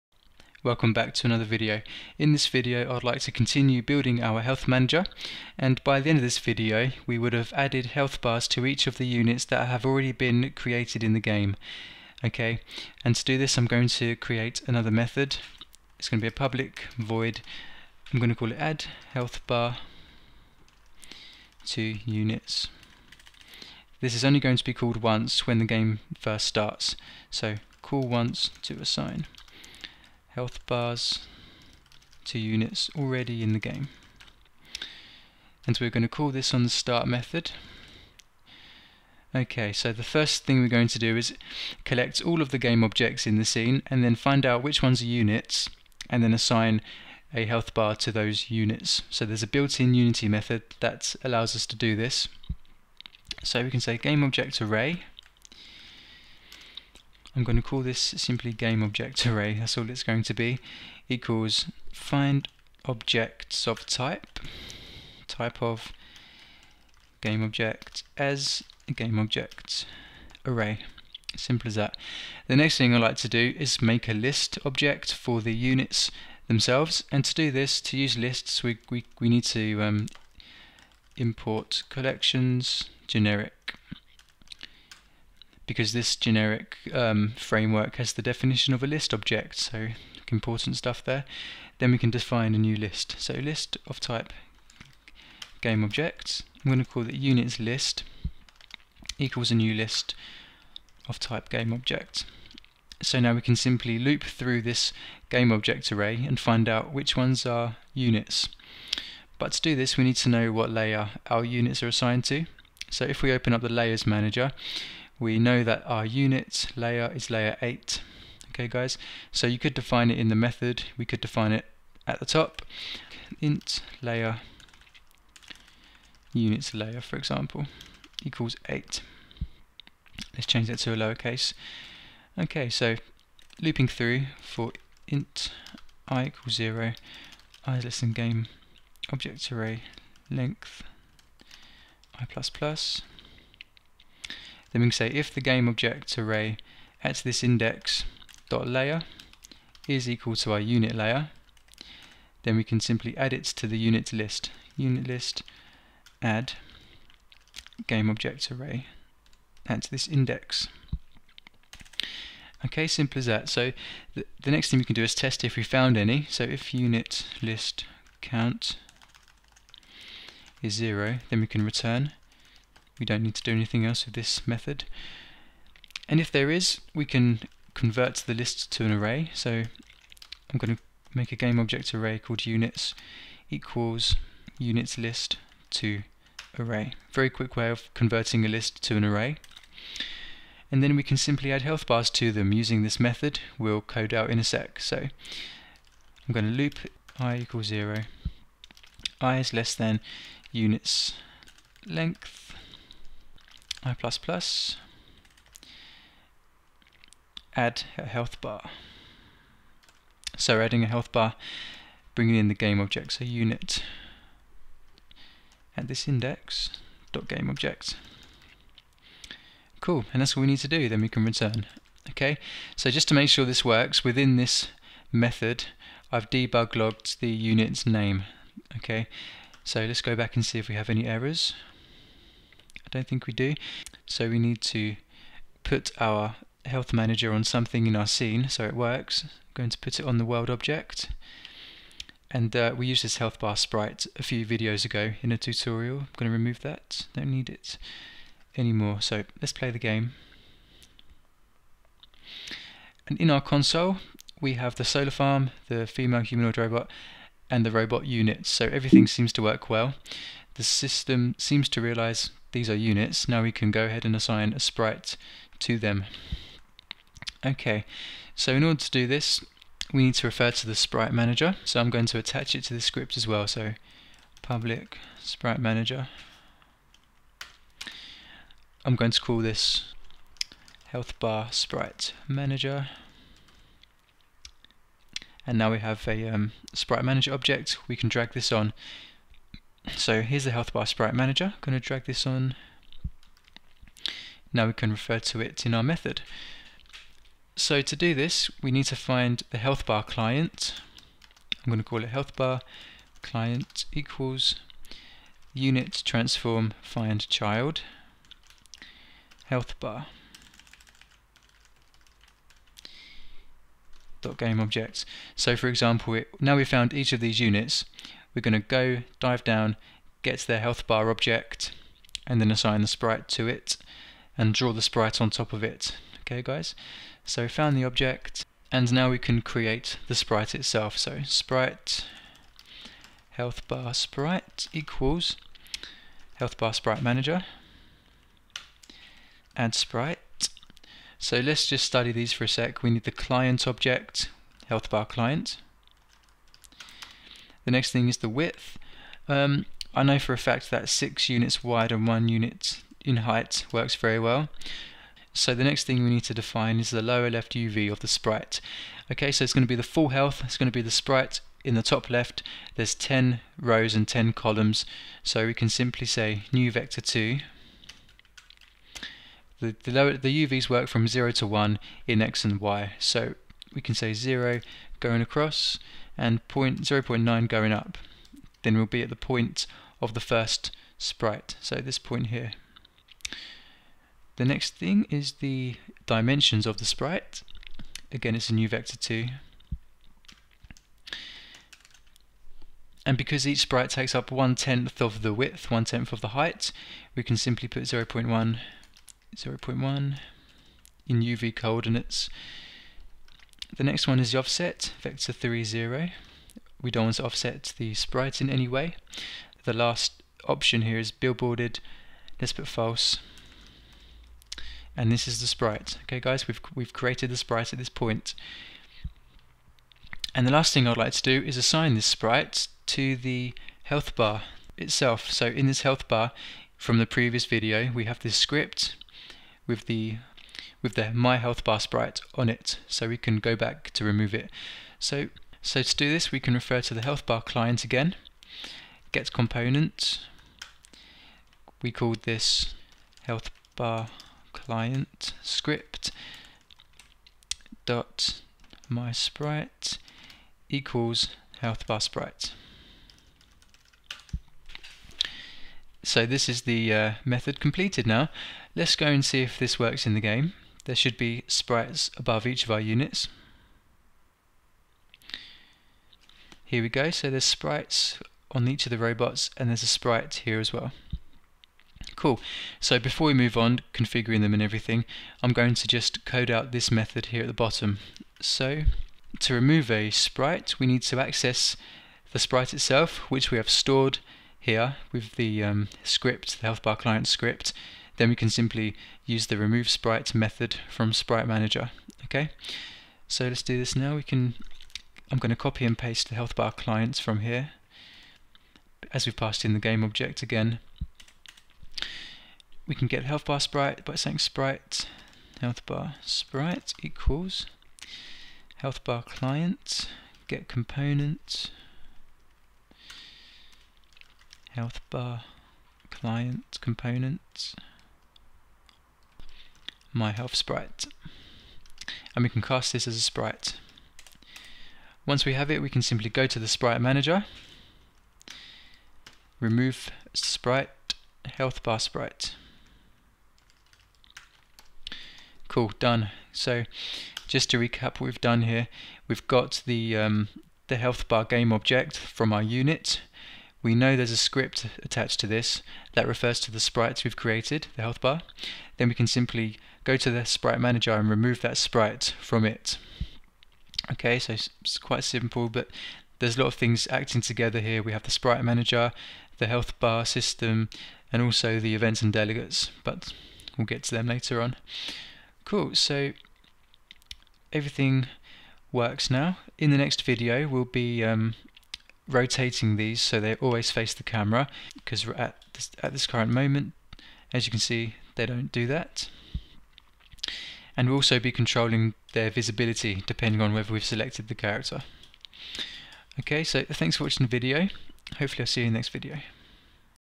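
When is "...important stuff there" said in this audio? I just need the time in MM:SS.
01:30.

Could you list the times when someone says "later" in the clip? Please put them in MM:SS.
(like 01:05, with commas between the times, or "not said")
09:24.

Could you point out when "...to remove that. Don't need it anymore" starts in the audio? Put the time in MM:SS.
04:06.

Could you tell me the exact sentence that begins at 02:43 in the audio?
So th the next thing we can do is test if we found any.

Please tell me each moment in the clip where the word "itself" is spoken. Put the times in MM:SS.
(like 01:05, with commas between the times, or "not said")
05:30, 07:04, 08:02.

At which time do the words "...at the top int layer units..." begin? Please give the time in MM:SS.
02:02.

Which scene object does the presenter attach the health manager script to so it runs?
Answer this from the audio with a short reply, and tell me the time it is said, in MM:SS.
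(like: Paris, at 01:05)
world object, at 04:00.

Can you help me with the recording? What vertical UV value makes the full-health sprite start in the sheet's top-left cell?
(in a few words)
0.9.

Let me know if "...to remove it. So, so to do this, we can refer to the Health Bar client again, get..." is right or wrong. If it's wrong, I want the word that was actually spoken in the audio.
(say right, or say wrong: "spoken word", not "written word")
right.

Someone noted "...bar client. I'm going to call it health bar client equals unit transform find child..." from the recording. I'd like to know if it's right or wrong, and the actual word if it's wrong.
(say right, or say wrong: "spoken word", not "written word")
right.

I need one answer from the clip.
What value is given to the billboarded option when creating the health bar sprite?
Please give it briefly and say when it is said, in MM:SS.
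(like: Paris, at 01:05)
false, at 06:52.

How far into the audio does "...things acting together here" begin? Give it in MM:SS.
09:16.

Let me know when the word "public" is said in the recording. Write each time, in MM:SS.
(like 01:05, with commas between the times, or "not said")
00:16, 04:34.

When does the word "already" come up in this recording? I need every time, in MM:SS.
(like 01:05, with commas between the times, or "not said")
00:09, 00:32.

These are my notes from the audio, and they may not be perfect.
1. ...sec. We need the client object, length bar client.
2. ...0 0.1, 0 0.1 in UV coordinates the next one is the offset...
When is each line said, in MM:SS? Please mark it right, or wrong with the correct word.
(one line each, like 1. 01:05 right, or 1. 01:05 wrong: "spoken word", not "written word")
1. 05:42 wrong: "health", not "length"
2. 06:37 right.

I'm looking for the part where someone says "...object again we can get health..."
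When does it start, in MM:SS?
08:20.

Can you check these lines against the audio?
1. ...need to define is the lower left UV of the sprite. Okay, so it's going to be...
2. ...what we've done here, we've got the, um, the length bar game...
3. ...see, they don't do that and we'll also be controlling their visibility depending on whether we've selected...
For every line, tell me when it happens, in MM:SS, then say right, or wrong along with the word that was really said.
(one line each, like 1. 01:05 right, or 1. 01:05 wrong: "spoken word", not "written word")
1. 05:56 right
2. 08:58 wrong: "health", not "length"
3. 09:37 right.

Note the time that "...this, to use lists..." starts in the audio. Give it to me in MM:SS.
01:17.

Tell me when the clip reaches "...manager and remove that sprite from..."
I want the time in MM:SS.
09:10.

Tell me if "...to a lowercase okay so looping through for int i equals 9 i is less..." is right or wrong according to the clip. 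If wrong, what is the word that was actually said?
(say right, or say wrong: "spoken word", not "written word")
wrong: "0", not "9".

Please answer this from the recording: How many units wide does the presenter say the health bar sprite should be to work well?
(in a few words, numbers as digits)
6.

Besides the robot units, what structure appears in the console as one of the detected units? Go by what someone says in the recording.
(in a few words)
solar farm.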